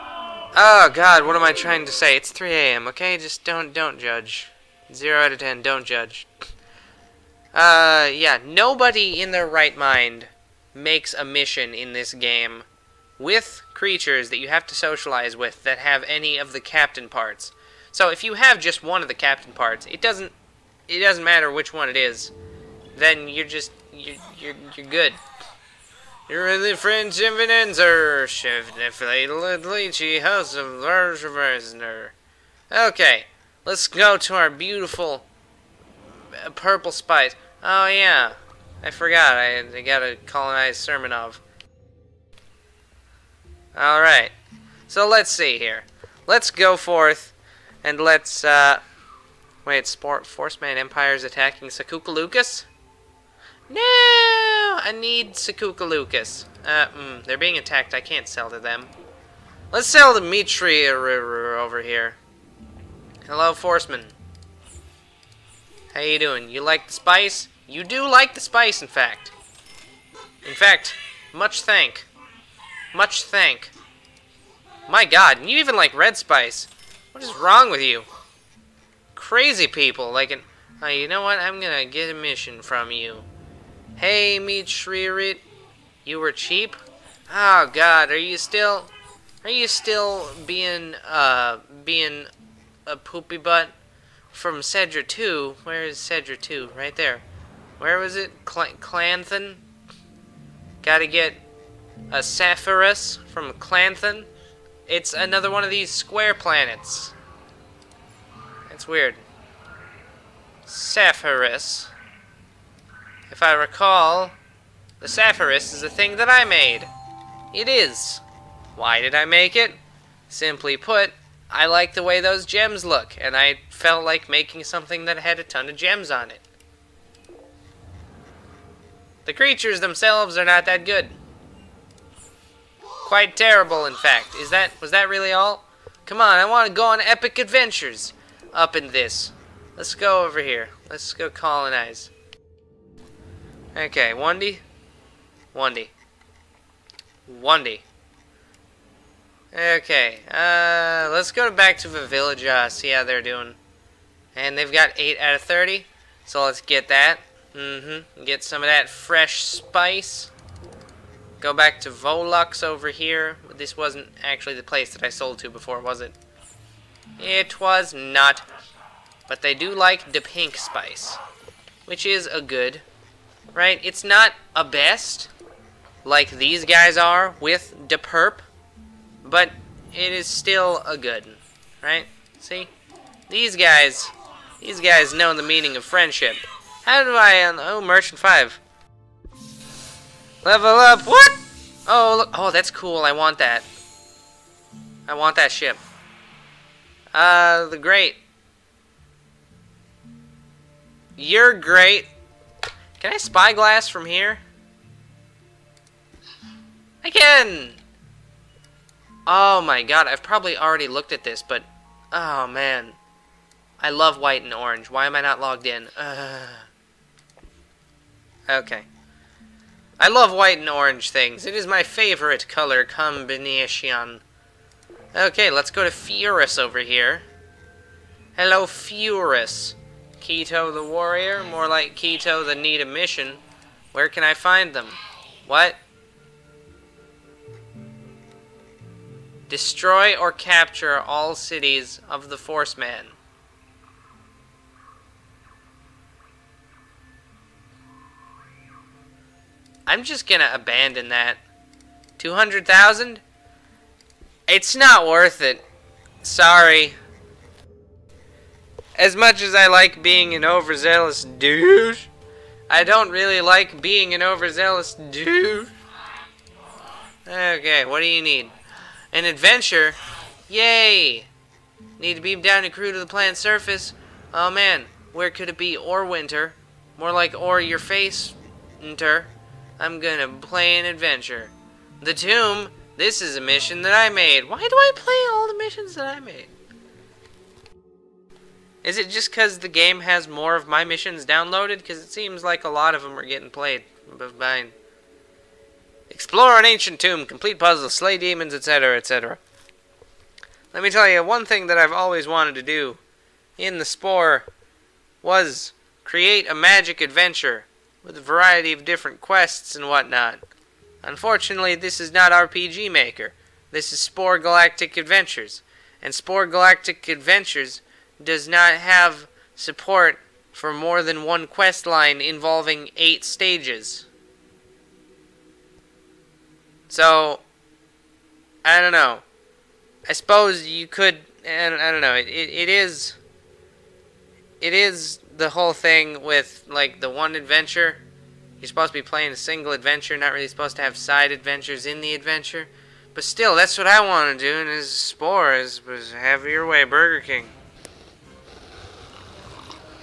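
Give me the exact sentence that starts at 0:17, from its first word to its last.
So if you have just one of the captain parts, it doesn't it doesn't matter which one it is.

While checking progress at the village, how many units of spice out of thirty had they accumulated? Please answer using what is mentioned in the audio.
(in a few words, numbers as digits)
8.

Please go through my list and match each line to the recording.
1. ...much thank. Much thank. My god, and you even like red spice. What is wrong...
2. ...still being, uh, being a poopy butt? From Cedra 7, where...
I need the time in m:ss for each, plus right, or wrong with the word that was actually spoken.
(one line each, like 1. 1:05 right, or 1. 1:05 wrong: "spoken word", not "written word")
1. 1:11 right
2. 1:29 wrong: "2", not "7".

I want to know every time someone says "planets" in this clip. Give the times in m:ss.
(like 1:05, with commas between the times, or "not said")
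1:46, 4:33.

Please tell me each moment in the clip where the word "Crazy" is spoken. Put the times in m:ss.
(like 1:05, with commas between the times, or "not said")
1:19.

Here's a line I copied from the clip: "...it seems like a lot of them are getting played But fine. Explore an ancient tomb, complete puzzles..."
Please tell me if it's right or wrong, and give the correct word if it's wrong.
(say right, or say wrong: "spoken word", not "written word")
right.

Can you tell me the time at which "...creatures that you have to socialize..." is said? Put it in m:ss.
0:13.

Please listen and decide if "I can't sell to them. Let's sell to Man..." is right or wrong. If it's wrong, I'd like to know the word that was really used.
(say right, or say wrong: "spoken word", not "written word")
wrong: "Mitri", not "Man".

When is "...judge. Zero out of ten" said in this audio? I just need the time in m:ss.
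0:03.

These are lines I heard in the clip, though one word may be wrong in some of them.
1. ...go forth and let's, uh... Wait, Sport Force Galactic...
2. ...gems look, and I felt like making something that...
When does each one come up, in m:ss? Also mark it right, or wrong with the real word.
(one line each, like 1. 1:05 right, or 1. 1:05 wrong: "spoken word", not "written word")
1. 0:46 wrong: "Man", not "Galactic"
2. 2:02 right.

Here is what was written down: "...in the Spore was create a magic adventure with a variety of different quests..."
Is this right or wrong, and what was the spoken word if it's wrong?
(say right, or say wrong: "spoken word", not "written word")
right.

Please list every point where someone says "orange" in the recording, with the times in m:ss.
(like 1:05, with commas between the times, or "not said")
3:34, 3:40.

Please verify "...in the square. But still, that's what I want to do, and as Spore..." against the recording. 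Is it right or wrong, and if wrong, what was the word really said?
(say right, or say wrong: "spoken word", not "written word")
wrong: "adventure", not "square".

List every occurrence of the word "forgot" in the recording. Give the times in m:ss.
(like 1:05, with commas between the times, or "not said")
0:38.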